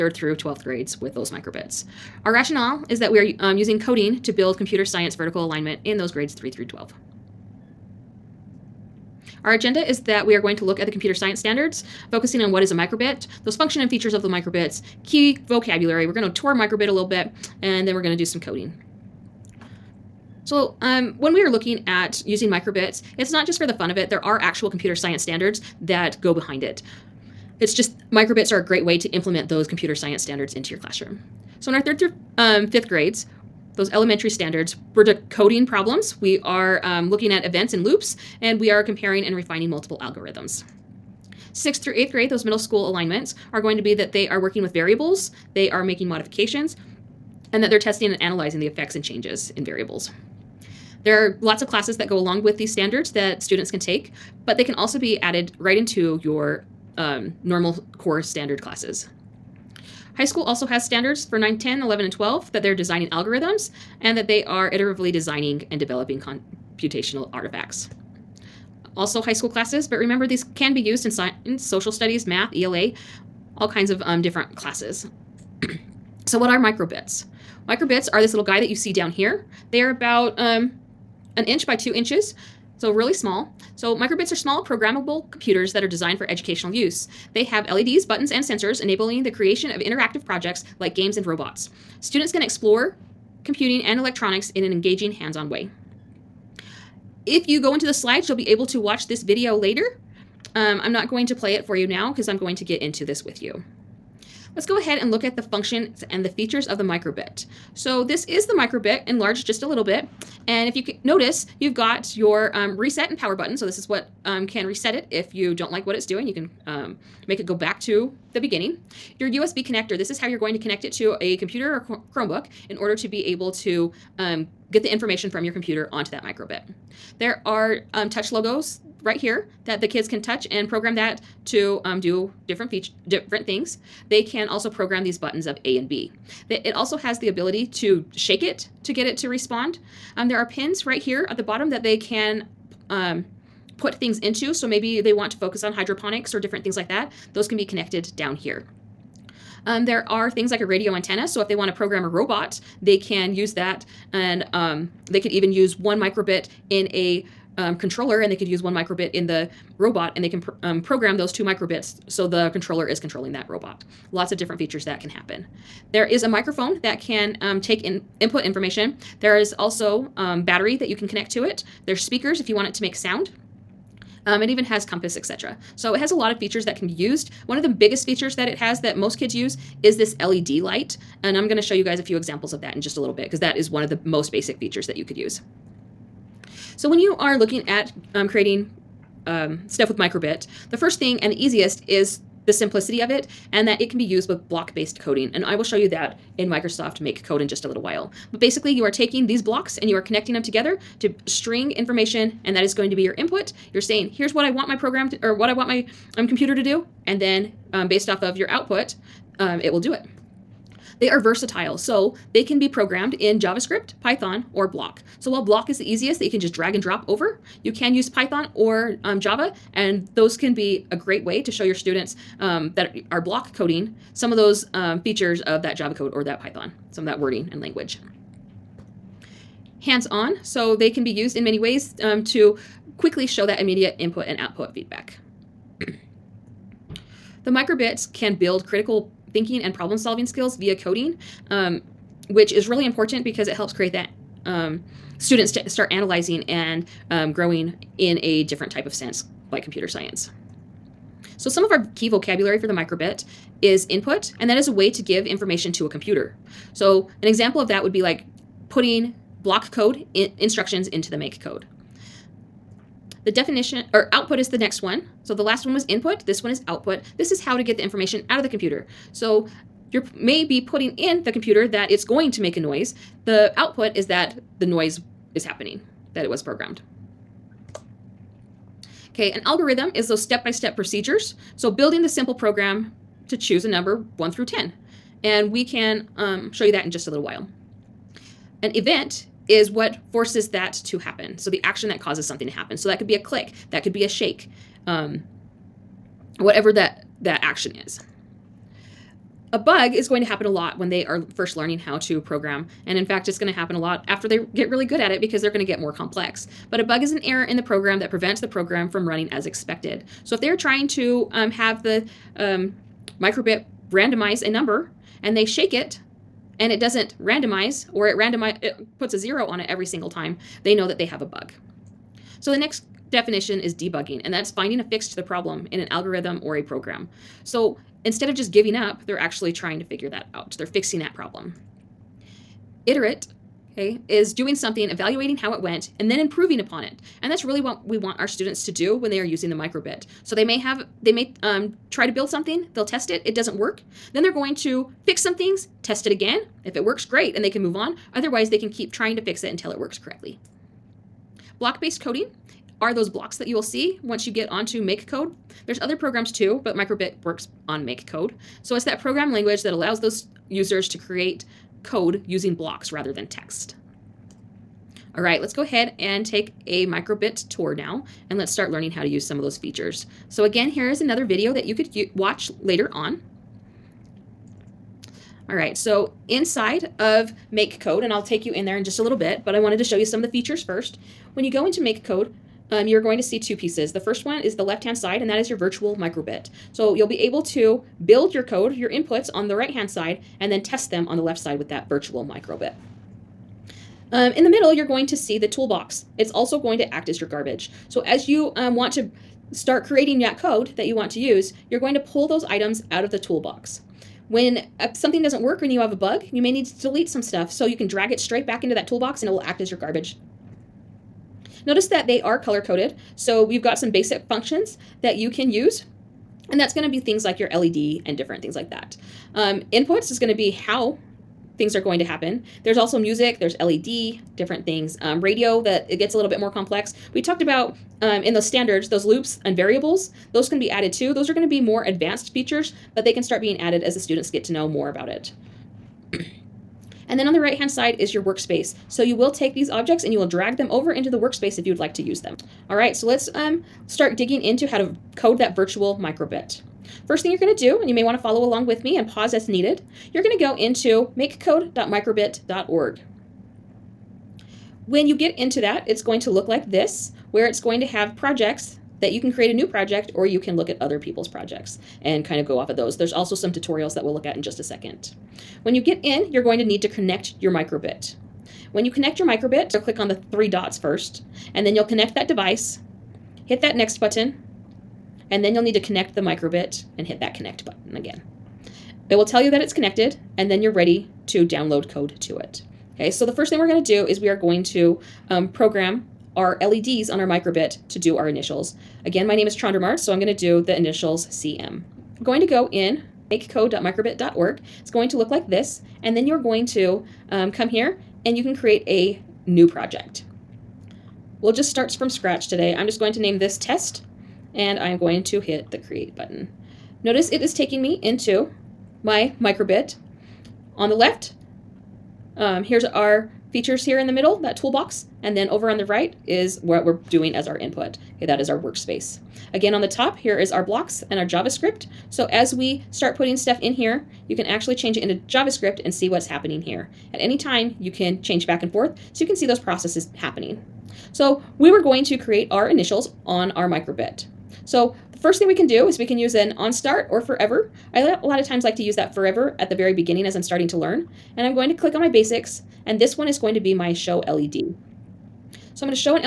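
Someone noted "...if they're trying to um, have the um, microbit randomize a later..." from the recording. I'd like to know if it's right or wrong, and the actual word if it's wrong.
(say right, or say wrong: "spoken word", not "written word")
wrong: "number", not "later".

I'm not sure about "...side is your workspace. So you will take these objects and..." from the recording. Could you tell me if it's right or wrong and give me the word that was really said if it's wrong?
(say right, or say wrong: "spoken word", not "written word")
right.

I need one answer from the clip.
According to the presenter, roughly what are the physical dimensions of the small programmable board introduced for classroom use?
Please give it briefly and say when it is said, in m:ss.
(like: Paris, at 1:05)
1 inch by 2 inches, at 1:21.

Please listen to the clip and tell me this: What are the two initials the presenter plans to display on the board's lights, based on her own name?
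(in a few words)
CM.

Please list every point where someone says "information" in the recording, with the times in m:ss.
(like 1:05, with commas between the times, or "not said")
2:04, 2:48, 3:21, 4:15, 4:27.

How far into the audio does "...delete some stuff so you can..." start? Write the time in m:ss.
6:46.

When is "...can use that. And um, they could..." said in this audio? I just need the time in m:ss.
2:32.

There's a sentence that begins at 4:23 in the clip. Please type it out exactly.
The definition or output is the next one.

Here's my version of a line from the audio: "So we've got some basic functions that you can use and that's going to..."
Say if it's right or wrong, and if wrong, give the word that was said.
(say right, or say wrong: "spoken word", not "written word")
right.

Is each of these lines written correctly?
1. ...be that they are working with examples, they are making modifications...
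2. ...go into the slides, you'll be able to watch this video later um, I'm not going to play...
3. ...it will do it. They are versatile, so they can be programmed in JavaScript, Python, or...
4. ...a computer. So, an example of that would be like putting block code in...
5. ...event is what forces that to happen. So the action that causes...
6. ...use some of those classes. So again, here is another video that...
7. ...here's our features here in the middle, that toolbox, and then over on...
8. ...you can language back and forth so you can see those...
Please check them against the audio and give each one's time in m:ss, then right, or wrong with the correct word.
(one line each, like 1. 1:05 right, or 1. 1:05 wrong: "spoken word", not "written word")
1. 0:43 wrong: "variables", not "examples"
2. 1:37 right
3. 3:29 right
4. 4:15 right
5. 4:48 right
6. 6:09 wrong: "features", not "classes"
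7. 8:32 right
8. 8:47 wrong: "change", not "language".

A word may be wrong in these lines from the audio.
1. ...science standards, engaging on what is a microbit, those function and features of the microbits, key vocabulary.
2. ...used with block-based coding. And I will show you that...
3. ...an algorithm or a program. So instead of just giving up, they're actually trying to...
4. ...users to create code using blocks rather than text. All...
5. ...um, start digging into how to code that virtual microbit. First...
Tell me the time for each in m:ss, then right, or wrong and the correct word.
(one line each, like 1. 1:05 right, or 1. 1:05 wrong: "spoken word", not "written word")
1. 0:11 wrong: "focusing", not "engaging"
2. 3:14 right
3. 5:25 right
4. 6:00 right
5. 7:23 right.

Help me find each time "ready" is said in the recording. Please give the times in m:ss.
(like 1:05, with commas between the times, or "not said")
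8:00.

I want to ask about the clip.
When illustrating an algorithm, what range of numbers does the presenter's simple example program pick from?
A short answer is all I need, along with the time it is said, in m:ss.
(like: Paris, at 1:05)
1 through 10, at 4:44.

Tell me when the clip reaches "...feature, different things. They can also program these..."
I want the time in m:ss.
2:12.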